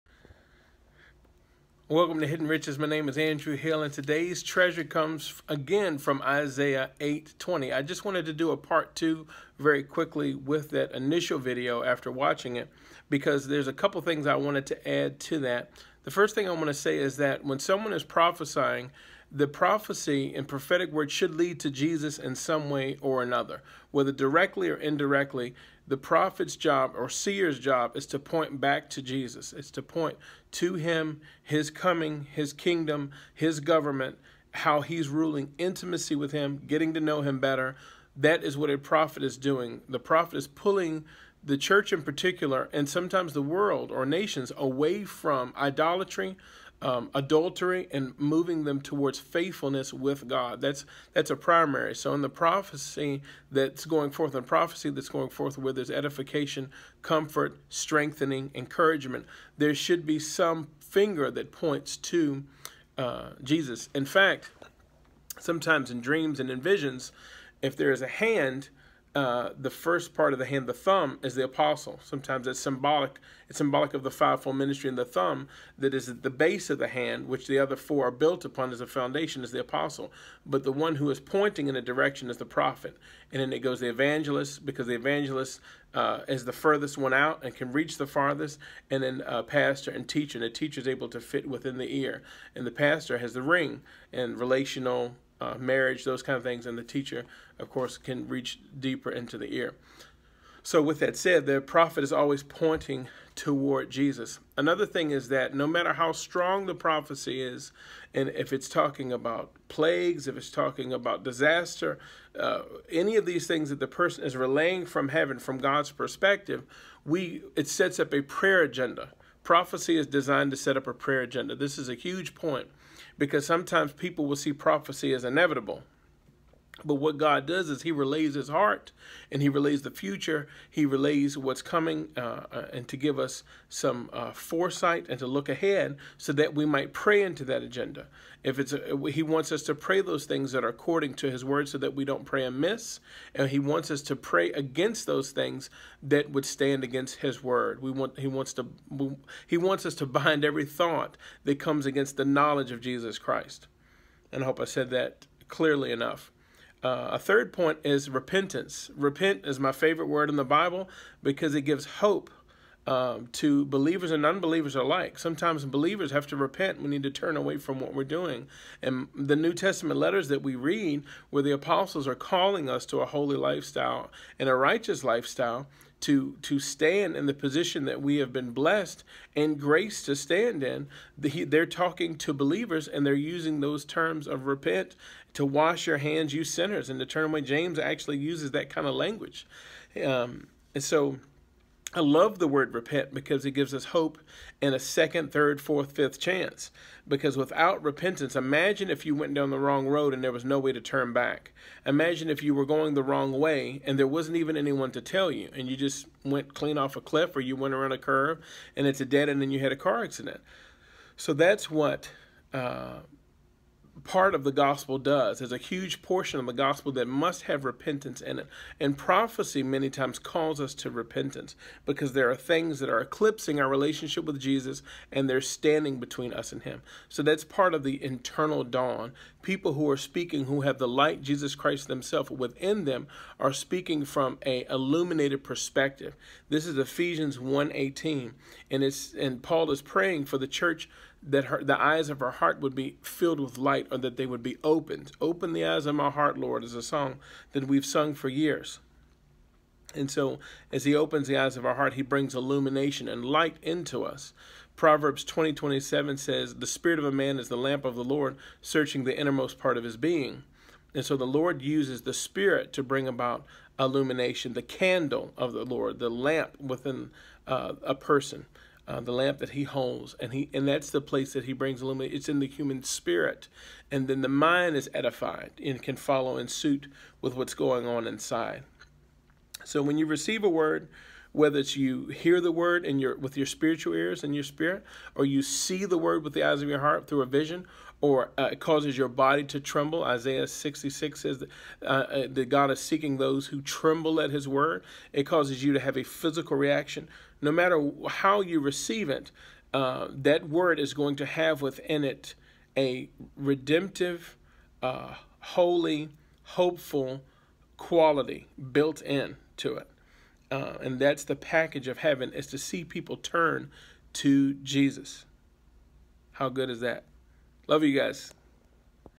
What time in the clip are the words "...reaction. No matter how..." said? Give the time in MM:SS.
04:56.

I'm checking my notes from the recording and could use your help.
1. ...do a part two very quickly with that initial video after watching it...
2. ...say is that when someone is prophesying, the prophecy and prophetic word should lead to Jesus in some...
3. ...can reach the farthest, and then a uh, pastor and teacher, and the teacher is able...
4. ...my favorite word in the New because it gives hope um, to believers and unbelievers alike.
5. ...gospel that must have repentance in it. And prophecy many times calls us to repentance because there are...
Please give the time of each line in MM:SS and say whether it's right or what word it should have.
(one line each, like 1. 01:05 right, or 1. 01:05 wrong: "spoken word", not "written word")
1. 00:08 right
2. 00:16 right
3. 01:27 right
4. 02:39 wrong: "Bible", not "New"
5. 03:36 right.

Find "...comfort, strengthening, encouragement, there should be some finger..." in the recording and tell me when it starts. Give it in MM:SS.
00:57.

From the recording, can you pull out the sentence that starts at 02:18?
If it's a, he wants us to pray those things that are according to his word so that we don't pray amiss.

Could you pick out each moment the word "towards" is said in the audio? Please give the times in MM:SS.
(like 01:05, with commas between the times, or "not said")
00:48, 01:43.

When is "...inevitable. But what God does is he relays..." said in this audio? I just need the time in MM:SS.
02:05.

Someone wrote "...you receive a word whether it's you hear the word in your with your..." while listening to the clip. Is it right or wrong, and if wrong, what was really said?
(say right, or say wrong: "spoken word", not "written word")
right.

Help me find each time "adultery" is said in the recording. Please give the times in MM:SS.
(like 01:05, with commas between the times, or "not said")
00:47.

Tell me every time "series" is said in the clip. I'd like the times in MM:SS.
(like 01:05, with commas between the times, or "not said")
not said.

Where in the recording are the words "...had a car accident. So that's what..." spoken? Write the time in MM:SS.
03:29.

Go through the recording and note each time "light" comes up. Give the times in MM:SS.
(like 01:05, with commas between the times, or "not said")
03:50, 04:03, 04:13.